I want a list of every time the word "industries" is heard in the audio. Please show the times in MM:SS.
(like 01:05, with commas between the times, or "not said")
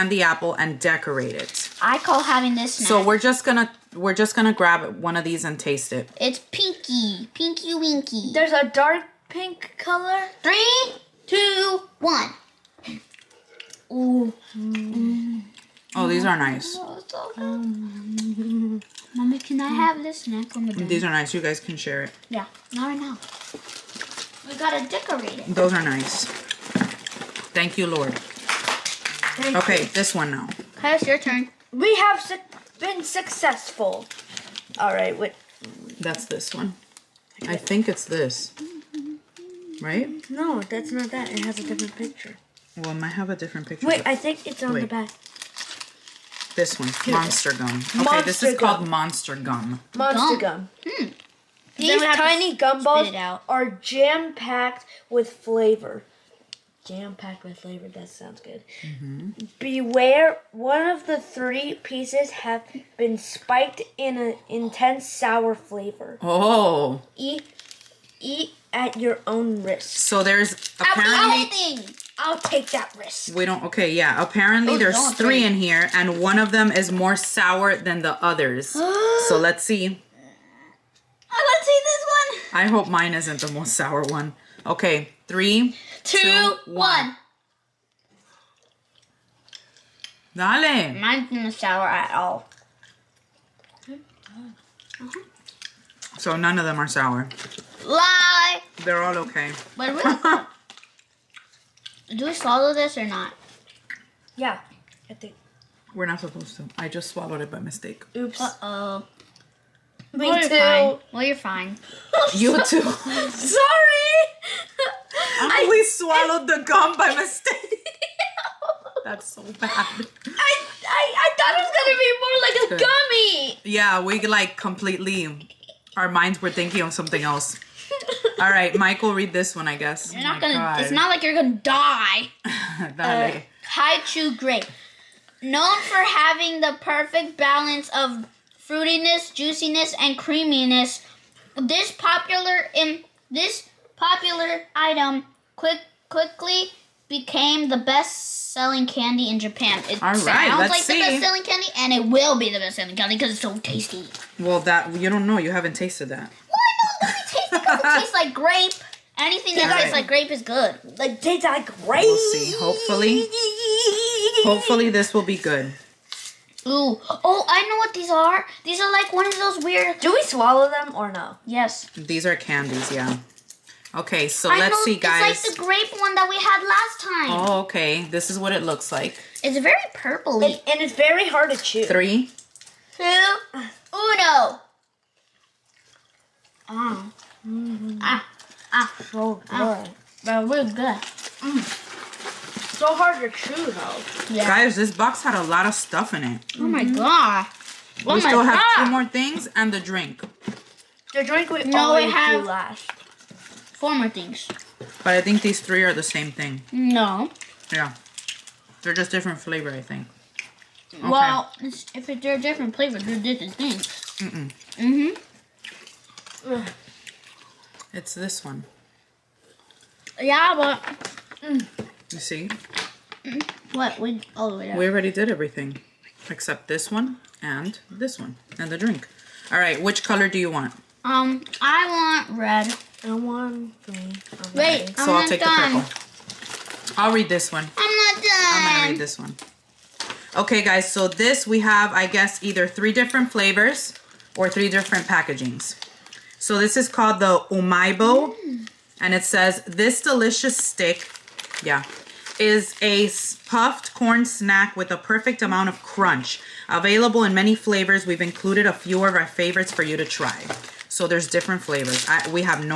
not said.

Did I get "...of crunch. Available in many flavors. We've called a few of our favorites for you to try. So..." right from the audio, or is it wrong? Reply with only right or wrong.
wrong.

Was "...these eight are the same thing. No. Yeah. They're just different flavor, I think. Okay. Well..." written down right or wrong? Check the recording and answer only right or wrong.
wrong.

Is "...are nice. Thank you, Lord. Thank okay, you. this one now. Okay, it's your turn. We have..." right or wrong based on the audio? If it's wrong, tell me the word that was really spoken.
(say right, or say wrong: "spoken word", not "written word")
right.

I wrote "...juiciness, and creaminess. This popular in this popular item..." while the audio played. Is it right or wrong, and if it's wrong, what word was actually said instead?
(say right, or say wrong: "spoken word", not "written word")
right.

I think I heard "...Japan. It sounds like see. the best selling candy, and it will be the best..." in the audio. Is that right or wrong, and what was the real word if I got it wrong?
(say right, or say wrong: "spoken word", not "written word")
right.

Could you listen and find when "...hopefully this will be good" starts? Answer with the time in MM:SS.
02:44.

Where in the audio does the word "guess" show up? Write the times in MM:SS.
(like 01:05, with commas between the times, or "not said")
02:09, 04:02.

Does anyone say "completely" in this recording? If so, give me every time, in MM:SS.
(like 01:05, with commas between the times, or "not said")
02:04.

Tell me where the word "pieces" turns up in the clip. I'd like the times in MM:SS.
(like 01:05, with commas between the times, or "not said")
01:01.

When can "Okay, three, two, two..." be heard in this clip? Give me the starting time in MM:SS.
01:24.